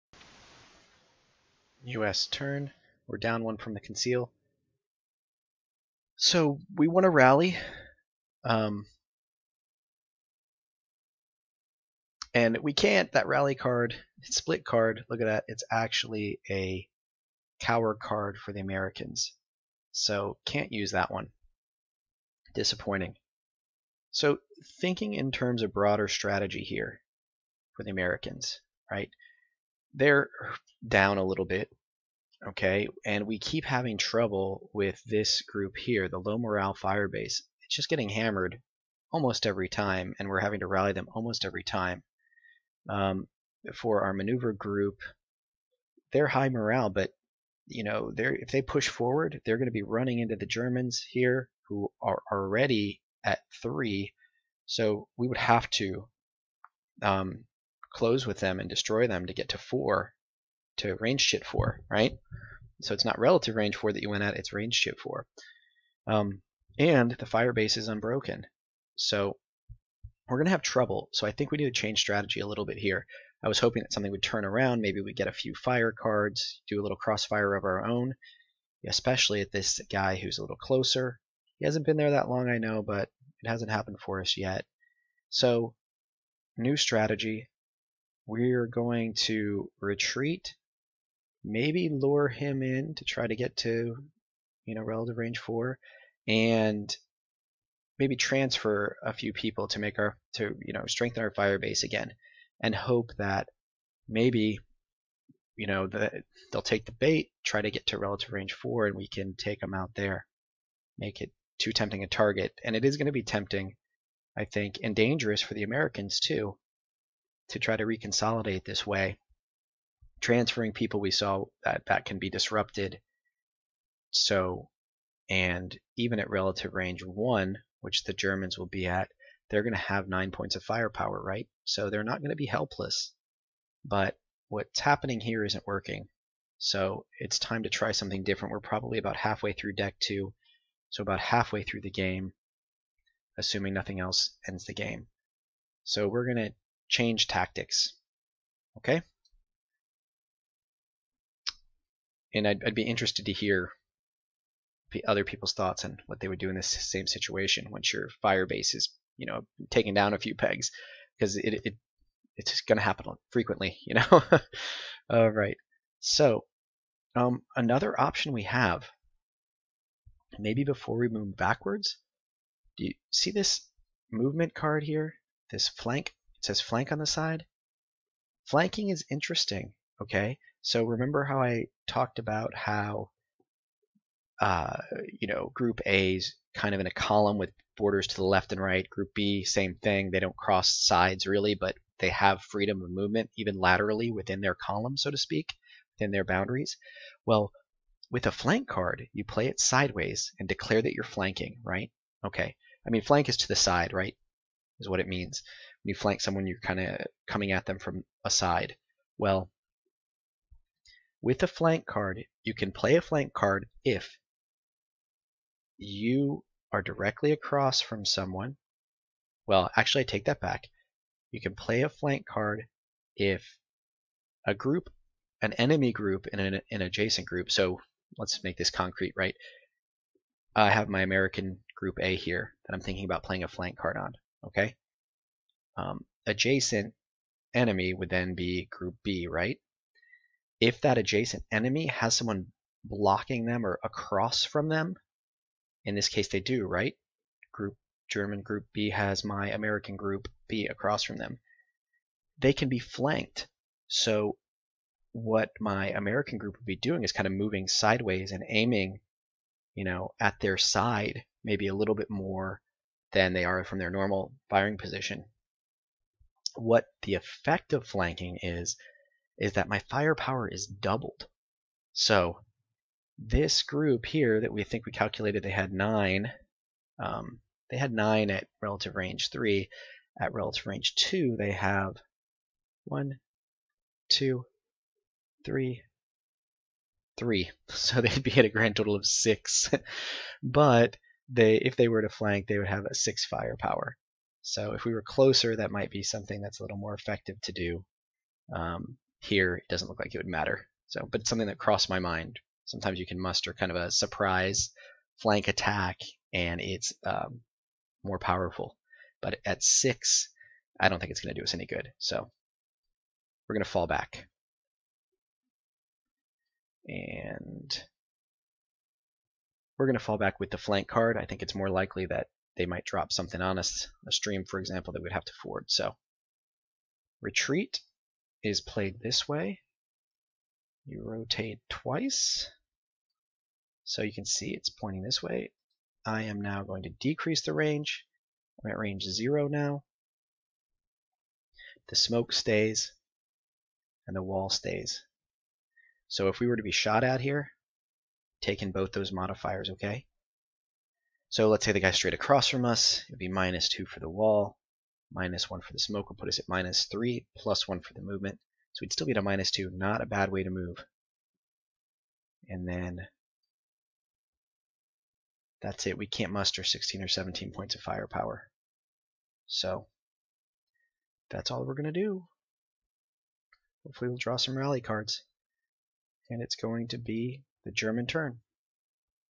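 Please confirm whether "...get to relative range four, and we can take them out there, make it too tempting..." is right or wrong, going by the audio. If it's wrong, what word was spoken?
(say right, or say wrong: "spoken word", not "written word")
right.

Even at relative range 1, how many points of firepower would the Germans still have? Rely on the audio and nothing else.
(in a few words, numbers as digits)
9.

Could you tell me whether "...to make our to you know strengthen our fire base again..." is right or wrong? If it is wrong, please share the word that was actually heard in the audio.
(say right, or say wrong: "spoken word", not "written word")
right.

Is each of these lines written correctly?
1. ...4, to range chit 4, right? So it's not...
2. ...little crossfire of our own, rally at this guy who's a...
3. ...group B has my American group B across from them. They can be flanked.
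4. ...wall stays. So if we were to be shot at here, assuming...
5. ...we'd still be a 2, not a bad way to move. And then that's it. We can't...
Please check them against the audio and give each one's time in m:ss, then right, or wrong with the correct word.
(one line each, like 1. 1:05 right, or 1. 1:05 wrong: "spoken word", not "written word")
1. 0:59 right
2. 1:16 wrong: "especially", not "rally"
3. 4:08 right
4. 5:44 wrong: "taking", not "assuming"
5. 5:58 right.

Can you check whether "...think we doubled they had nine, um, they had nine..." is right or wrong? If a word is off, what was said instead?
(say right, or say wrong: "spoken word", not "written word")
wrong: "calculated", not "doubled".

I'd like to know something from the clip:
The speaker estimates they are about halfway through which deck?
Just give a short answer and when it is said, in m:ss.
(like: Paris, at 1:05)
deck 2, at 2:19.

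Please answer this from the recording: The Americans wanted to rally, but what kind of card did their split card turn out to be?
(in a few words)
cower card.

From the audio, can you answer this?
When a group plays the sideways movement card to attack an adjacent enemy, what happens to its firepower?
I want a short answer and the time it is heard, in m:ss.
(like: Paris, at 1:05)
doubled, at 4:30.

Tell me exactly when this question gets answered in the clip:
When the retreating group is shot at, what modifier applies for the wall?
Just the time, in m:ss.
5:53.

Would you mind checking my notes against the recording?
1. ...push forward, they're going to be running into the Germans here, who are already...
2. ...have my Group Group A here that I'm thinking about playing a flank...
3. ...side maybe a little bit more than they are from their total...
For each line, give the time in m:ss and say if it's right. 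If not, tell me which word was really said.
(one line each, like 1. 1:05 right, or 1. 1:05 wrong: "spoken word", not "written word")
1. 0:48 right
2. 3:50 wrong: "American", not "Group"
3. 4:20 wrong: "normal", not "total".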